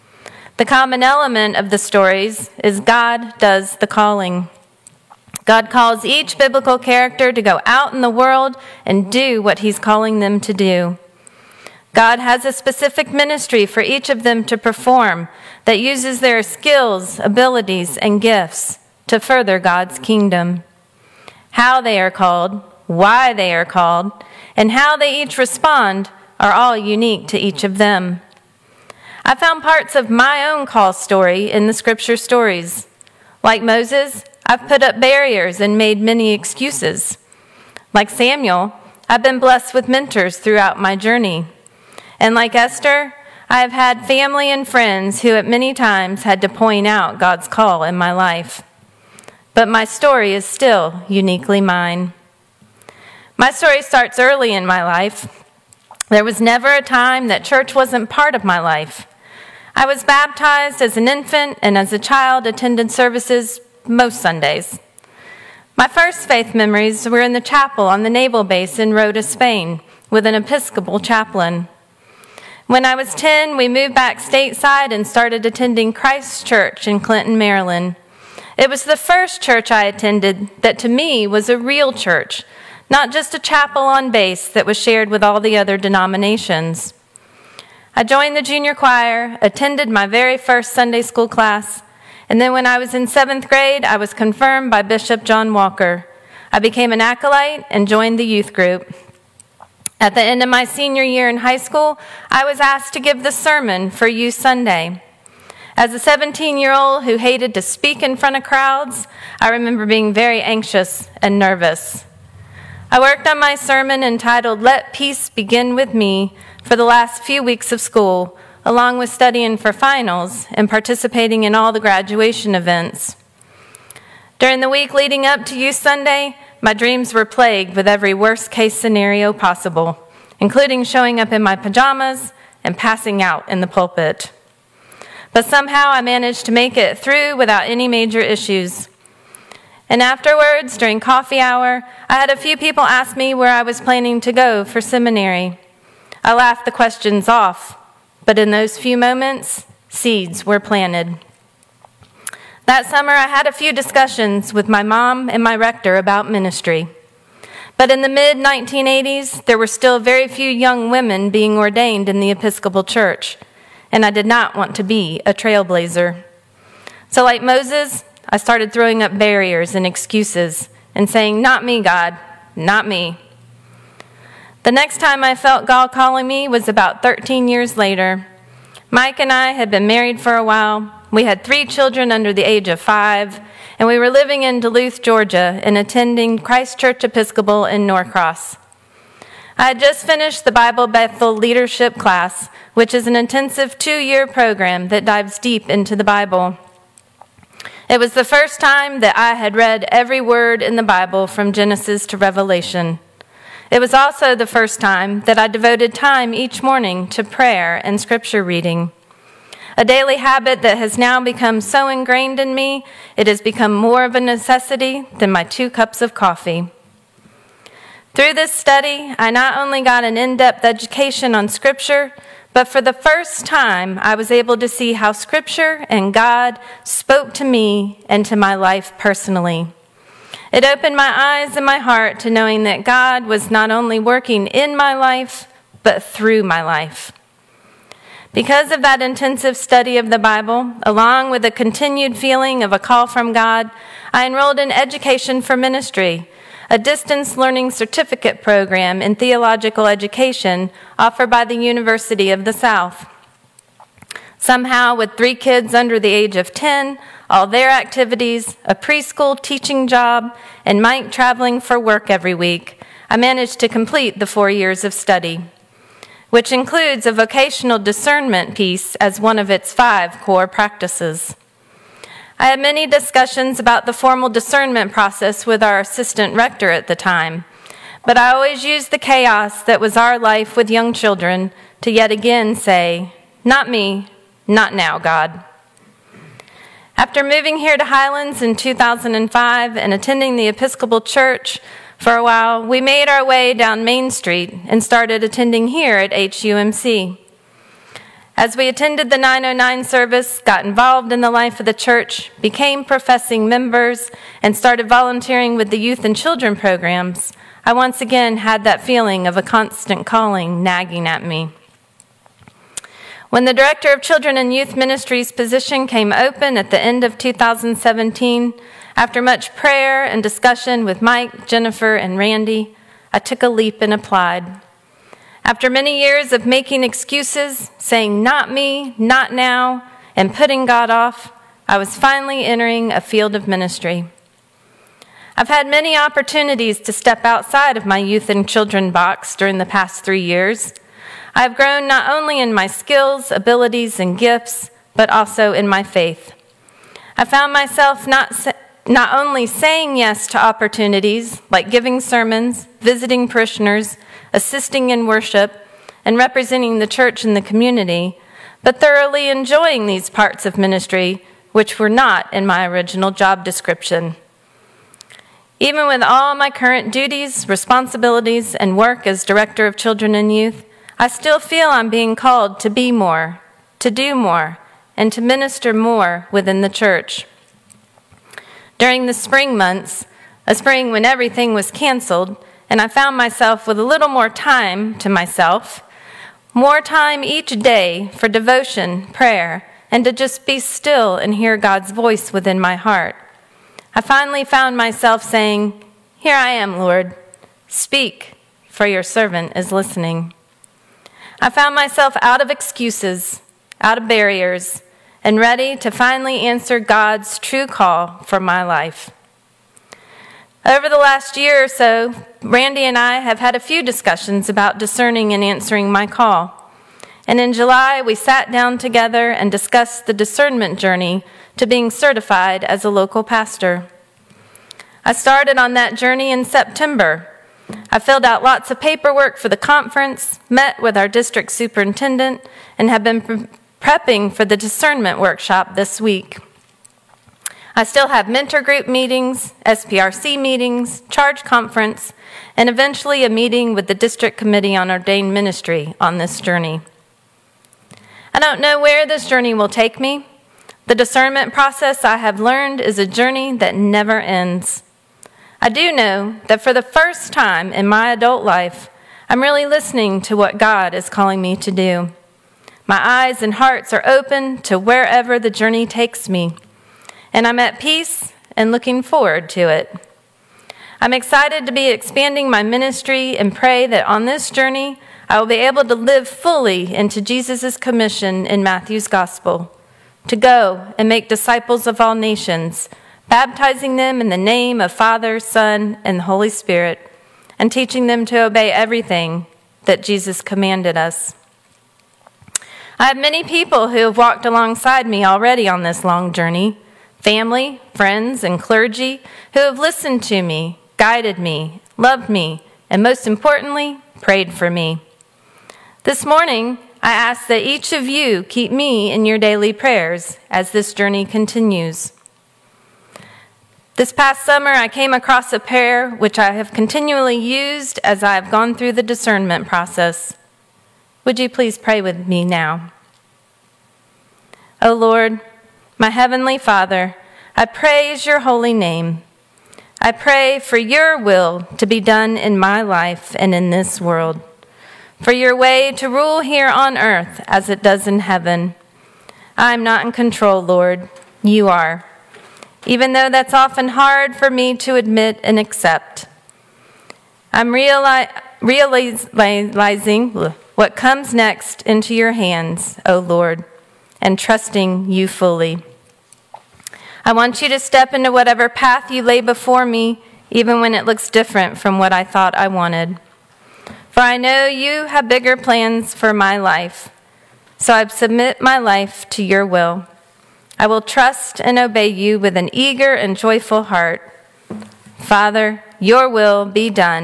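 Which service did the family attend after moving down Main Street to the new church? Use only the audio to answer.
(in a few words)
909 service.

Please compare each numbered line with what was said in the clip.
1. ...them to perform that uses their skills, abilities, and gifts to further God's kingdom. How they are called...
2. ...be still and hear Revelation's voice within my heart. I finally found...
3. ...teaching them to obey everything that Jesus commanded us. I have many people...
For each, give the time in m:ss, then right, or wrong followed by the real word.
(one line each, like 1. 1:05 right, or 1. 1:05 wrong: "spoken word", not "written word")
1. 0:14 right
2. 6:30 wrong: "God", not "Revelation"
3. 8:07 right.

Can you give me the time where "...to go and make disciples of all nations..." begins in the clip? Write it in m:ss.
8:00.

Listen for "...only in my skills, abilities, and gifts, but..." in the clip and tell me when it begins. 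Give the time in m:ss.
5:42.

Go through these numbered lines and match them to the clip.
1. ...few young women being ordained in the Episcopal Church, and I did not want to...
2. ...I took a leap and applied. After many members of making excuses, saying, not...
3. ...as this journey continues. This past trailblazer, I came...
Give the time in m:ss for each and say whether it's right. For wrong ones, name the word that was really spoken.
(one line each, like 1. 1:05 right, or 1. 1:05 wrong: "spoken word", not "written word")
1. 2:40 right
2. 5:23 wrong: "years", not "members"
3. 8:30 wrong: "summer", not "trailblazer".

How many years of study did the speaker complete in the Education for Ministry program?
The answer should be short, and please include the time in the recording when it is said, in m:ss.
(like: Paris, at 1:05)
4, at 4:24.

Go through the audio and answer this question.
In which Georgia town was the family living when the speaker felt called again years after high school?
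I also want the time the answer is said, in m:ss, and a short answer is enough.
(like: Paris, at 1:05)
Duluth, at 3:04.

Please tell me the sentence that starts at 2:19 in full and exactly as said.
And afterwards, during coffee hour, I had a few people ask me where I was planning to go for seminary.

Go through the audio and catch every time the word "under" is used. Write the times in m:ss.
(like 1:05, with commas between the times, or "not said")
3:02, 4:15.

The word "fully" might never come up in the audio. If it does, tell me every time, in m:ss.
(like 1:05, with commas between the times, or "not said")
7:56, 9:15.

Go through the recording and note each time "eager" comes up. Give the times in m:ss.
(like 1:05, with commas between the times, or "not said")
9:32.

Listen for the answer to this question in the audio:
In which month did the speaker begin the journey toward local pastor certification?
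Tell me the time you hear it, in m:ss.
7:06.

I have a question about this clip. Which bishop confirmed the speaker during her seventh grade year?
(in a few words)
Bishop John Walker.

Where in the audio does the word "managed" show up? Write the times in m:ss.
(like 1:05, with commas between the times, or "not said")
2:16, 4:23.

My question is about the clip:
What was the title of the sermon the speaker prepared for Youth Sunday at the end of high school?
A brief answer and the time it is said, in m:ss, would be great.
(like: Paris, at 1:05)
Let Peace Begin With Me, at 1:54.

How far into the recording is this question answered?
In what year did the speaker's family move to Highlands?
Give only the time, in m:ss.
4:48.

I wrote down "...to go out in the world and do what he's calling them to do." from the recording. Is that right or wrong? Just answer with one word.
right.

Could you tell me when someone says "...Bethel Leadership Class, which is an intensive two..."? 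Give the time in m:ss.
3:10.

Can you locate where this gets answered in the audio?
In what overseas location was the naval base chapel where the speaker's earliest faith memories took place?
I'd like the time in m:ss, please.
1:08.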